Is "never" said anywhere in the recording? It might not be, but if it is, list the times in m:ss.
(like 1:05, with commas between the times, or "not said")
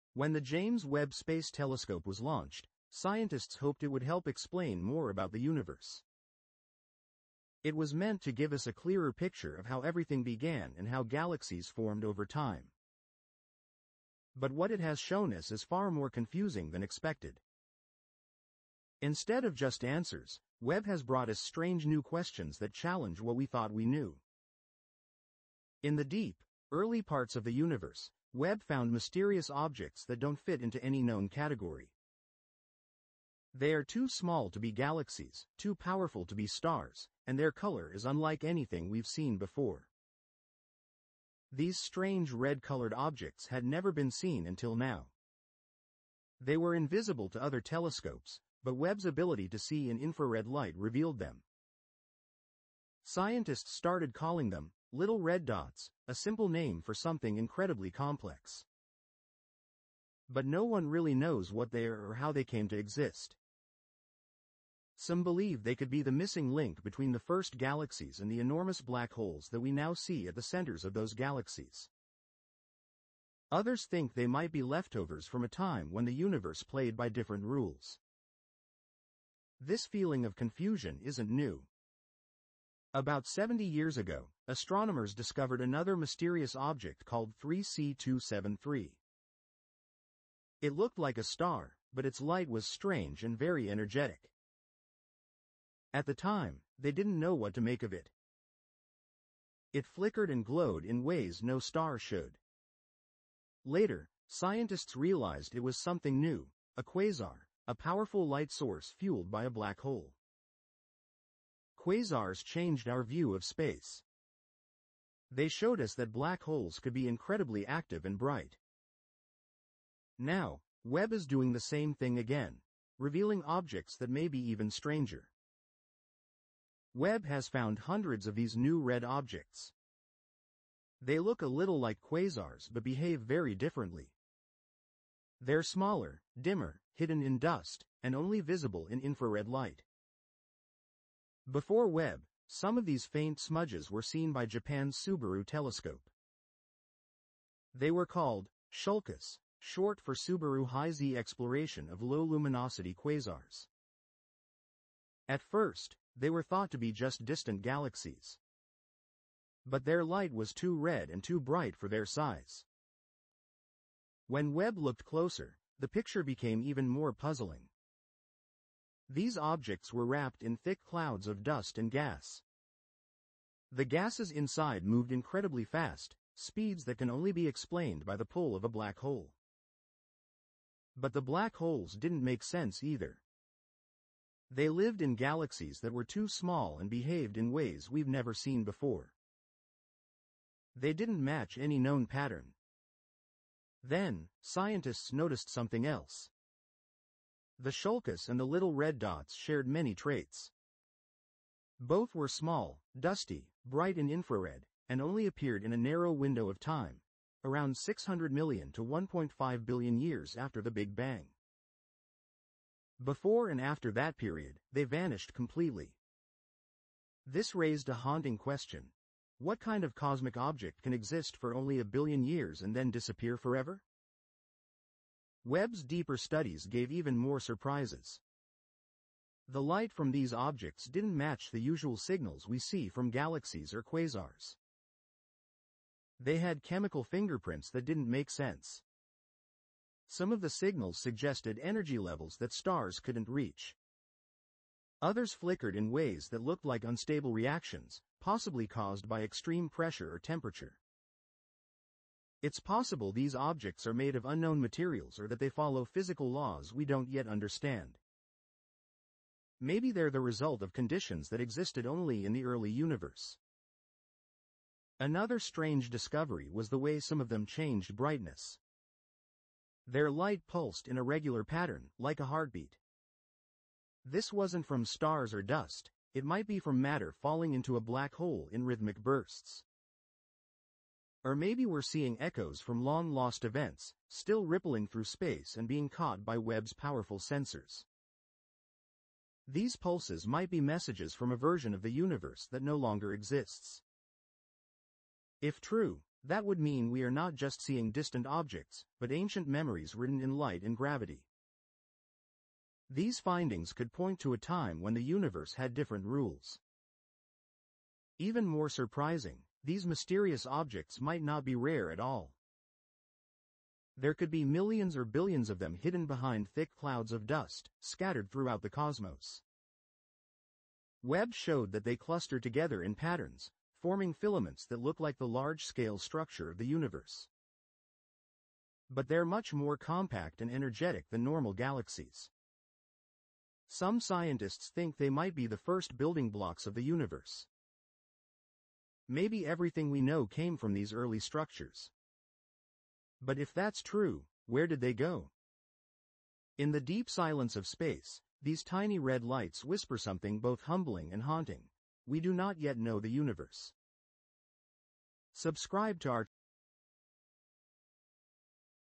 0:43, 3:08.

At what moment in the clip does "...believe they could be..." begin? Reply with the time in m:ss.
1:05.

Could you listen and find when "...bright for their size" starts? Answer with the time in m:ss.
2:41.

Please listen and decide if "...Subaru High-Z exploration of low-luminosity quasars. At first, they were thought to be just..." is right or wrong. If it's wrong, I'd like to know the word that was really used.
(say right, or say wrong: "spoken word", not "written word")
right.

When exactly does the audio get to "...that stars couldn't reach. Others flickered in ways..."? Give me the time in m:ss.
4:02.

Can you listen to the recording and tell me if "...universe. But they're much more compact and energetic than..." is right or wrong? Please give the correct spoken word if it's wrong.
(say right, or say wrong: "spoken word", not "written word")
right.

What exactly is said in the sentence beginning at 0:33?
They are too small to be galaxies, too powerful to be stars, and their color is unlike anything we've seen before.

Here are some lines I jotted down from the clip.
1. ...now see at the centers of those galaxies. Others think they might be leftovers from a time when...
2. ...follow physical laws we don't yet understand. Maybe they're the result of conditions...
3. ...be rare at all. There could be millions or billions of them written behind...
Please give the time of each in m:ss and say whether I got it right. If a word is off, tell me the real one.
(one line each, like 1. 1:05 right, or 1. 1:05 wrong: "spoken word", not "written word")
1. 1:09 right
2. 4:15 right
3. 5:11 wrong: "hidden", not "written".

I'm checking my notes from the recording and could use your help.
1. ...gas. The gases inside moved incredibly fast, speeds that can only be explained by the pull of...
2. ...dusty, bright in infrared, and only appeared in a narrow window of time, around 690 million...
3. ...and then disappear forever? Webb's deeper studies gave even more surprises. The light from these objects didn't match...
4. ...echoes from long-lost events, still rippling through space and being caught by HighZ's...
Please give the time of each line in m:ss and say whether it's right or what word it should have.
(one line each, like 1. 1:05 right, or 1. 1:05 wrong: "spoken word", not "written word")
1. 2:51 right
2. 3:22 wrong: "600", not "690"
3. 3:42 right
4. 4:42 wrong: "Webb", not "HighZ".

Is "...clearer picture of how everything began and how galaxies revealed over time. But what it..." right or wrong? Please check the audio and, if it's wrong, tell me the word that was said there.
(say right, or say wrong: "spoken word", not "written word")
wrong: "formed", not "revealed".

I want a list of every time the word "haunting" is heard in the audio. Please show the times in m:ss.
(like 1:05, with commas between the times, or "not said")
3:37, 5:51.